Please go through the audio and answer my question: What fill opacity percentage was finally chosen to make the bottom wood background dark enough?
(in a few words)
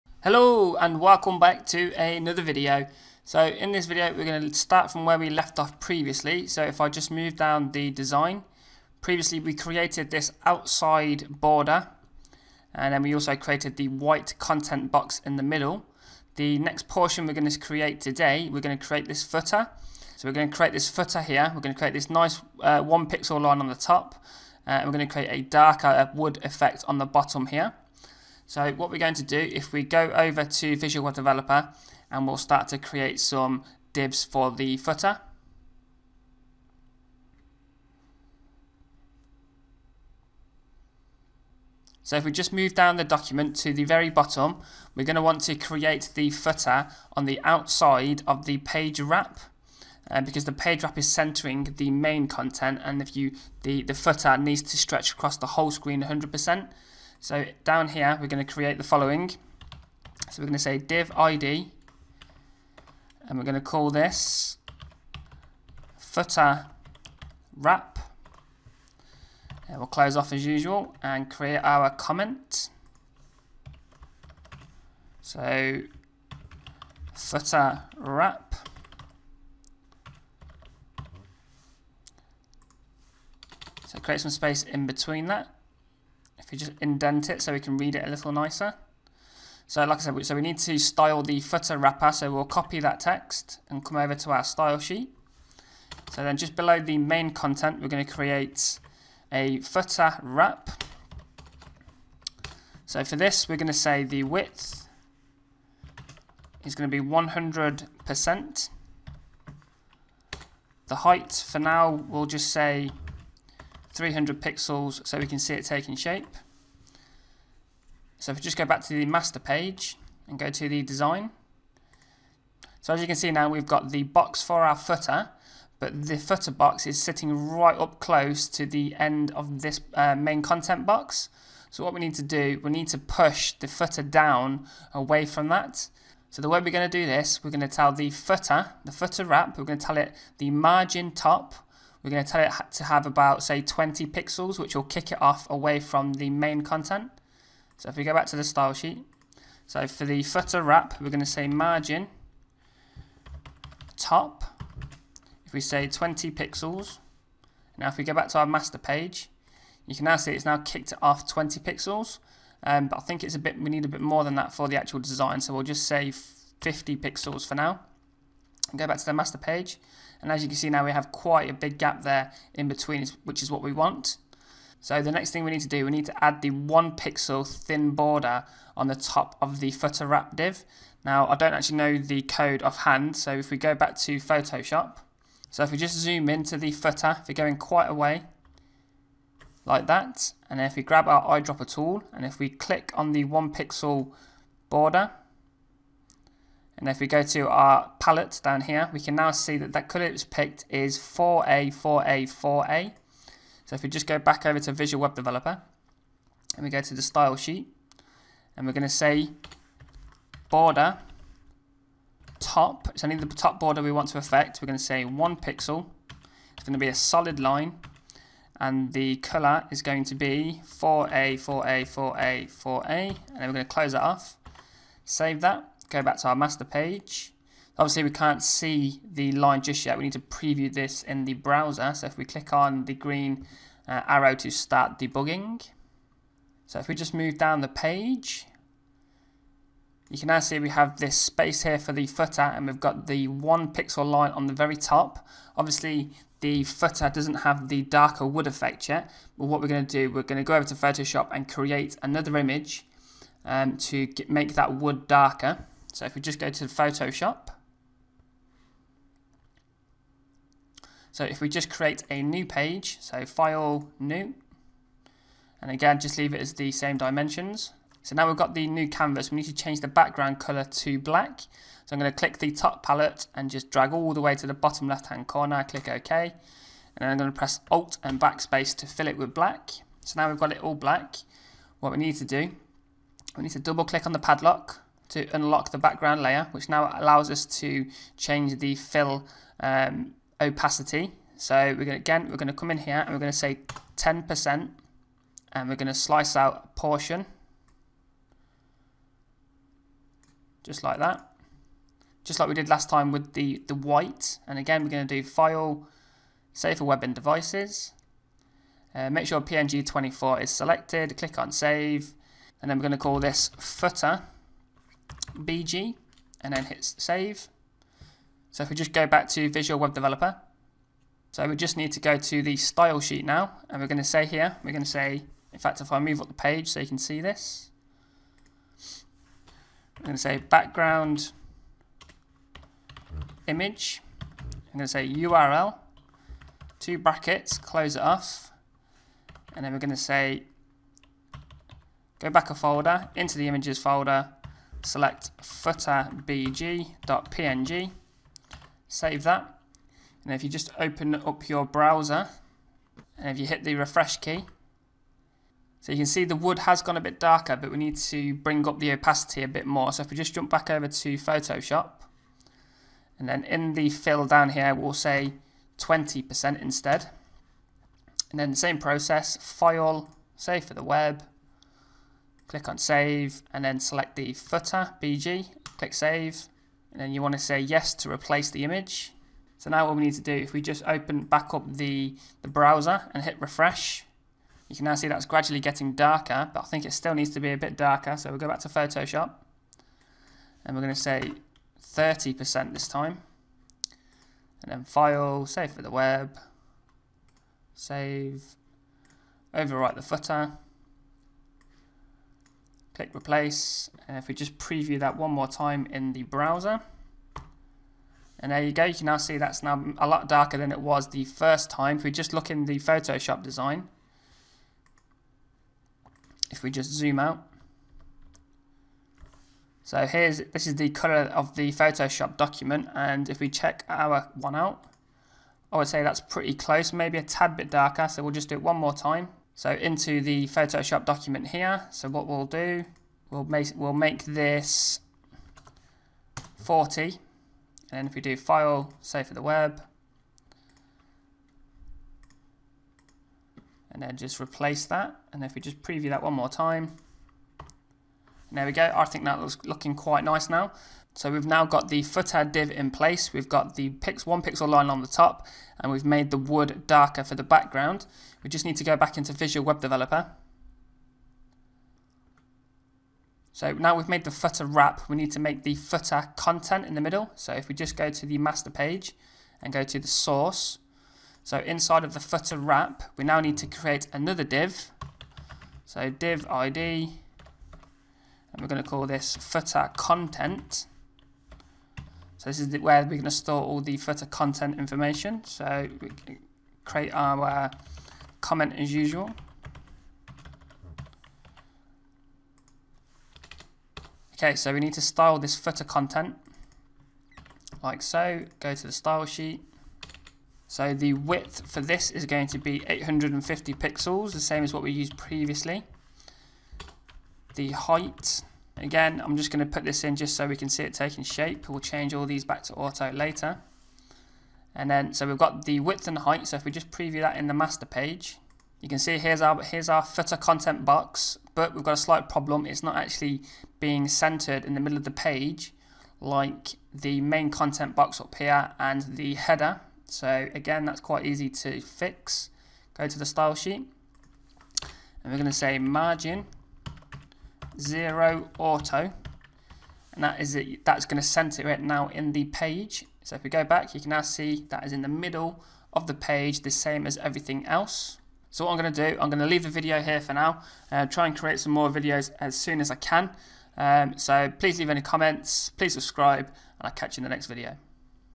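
40.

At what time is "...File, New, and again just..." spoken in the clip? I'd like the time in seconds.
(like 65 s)
263 s.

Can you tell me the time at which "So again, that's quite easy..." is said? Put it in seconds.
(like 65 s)
530 s.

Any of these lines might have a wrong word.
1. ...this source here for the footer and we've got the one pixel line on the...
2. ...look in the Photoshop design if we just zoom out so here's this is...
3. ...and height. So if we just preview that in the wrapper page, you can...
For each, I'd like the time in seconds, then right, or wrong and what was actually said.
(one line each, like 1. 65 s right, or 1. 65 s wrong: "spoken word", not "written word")
1. 240 s wrong: "space", not "source"
2. 412 s right
3. 516 s wrong: "master", not "wrapper".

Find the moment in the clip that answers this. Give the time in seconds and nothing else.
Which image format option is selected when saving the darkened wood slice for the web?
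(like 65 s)
309 s.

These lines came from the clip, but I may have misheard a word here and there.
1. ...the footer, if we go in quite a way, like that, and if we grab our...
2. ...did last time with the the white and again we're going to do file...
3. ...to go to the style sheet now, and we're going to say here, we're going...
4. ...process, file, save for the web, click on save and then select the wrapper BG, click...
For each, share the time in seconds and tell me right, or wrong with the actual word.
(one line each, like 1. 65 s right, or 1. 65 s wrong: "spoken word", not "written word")
1. 186 s right
2. 302 s right
3. 321 s right
4. 368 s wrong: "footer", not "wrapper".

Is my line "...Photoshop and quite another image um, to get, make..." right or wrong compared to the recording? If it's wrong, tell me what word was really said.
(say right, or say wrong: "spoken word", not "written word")
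wrong: "create", not "quite".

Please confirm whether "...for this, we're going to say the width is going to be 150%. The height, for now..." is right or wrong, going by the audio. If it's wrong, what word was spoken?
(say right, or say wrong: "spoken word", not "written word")
wrong: "100", not "150".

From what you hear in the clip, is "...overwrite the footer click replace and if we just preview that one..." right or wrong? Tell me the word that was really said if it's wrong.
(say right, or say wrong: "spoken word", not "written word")
right.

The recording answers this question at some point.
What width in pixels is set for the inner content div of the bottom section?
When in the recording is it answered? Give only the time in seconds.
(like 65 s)
502 s.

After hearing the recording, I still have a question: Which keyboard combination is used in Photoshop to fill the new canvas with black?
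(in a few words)
Alt and Backspace.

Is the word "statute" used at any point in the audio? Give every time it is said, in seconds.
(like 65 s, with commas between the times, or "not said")
not said.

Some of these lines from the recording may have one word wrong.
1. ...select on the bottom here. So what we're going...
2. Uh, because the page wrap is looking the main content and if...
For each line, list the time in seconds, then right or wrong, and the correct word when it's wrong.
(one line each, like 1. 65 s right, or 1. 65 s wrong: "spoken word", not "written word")
1. 26 s wrong: "effect", not "select"
2. 50 s wrong: "centering", not "looking".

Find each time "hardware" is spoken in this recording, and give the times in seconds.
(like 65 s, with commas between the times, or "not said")
not said.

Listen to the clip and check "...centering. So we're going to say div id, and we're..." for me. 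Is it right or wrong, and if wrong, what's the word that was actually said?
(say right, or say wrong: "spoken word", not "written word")
wrong: "following", not "centering".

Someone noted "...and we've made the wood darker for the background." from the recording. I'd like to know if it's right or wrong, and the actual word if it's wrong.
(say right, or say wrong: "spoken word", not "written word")
right.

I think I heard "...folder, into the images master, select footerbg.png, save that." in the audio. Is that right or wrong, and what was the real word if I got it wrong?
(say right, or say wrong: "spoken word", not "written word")
wrong: "folder", not "master".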